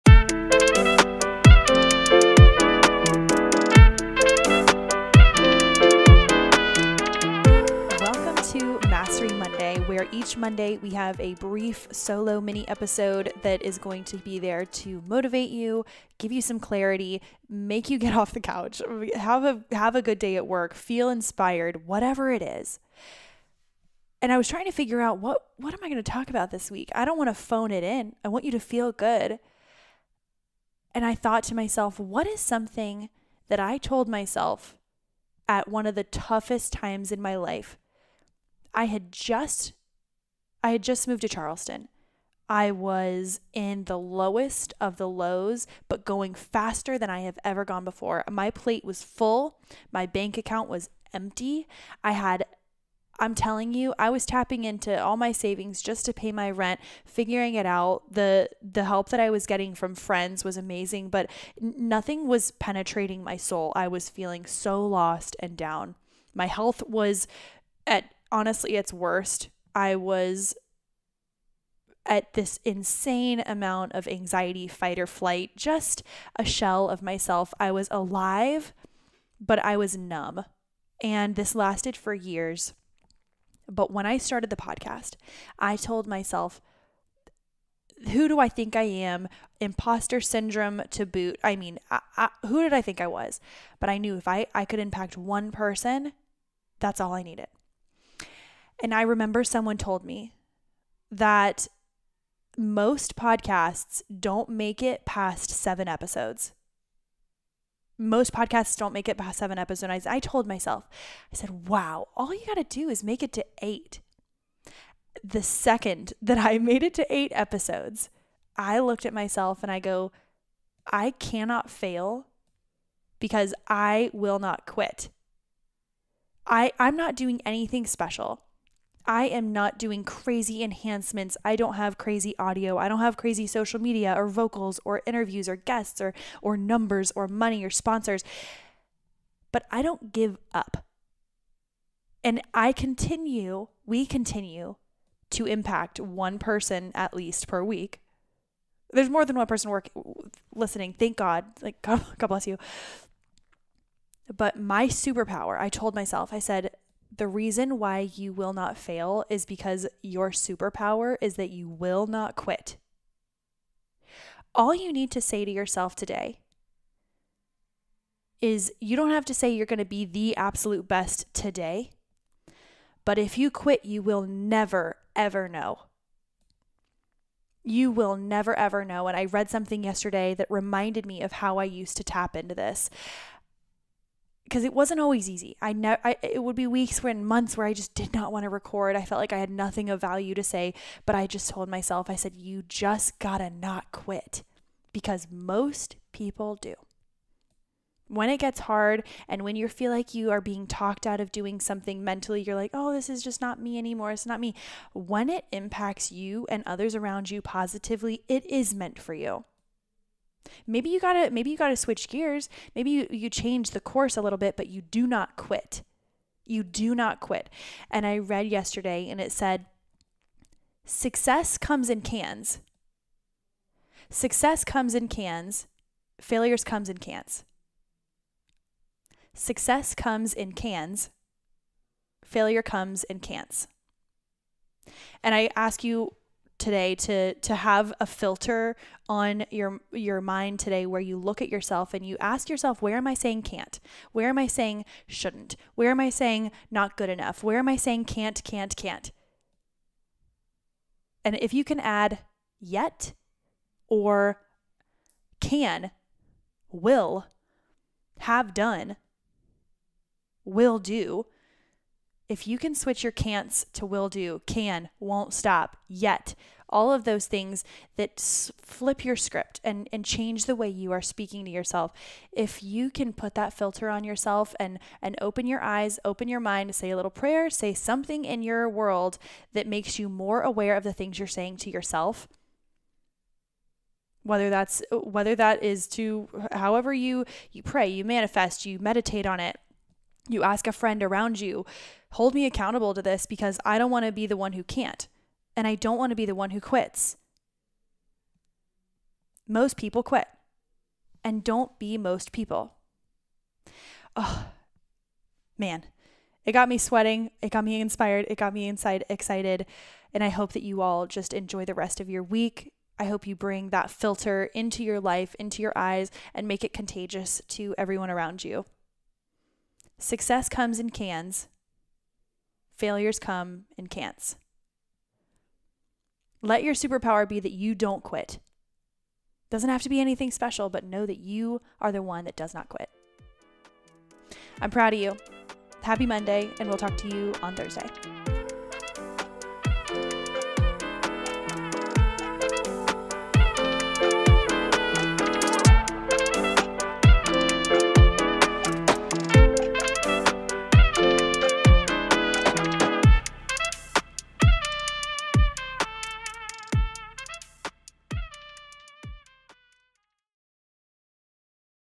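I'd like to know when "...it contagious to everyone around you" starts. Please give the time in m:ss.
5:16.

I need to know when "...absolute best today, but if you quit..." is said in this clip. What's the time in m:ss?
2:50.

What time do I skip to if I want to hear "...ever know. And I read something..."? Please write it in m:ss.
2:58.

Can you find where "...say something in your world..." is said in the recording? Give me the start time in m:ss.
4:37.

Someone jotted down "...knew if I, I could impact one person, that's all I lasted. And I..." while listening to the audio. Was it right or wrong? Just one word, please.
wrong.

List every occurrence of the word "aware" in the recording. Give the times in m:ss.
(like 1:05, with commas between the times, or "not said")
4:40.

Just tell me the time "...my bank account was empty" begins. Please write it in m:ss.
0:49.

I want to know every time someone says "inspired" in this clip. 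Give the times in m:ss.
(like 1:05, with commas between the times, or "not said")
0:21, 5:07.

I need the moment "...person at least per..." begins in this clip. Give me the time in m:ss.
2:26.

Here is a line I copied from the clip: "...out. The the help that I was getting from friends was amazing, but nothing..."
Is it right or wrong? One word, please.
right.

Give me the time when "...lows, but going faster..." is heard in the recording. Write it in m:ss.
0:45.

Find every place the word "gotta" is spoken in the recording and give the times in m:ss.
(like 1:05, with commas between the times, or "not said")
3:13.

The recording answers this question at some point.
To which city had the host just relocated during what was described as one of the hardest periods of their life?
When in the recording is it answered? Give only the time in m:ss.
0:41.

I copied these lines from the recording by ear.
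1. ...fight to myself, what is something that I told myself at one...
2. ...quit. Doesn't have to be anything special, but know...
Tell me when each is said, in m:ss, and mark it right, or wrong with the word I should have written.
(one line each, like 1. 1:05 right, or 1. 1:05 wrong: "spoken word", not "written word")
1. 0:31 wrong: "thought", not "fight"
2. 5:28 right.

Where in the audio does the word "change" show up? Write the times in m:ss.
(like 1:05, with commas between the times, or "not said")
3:33, 4:30.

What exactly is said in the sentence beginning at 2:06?
I, I'm not doing anything special.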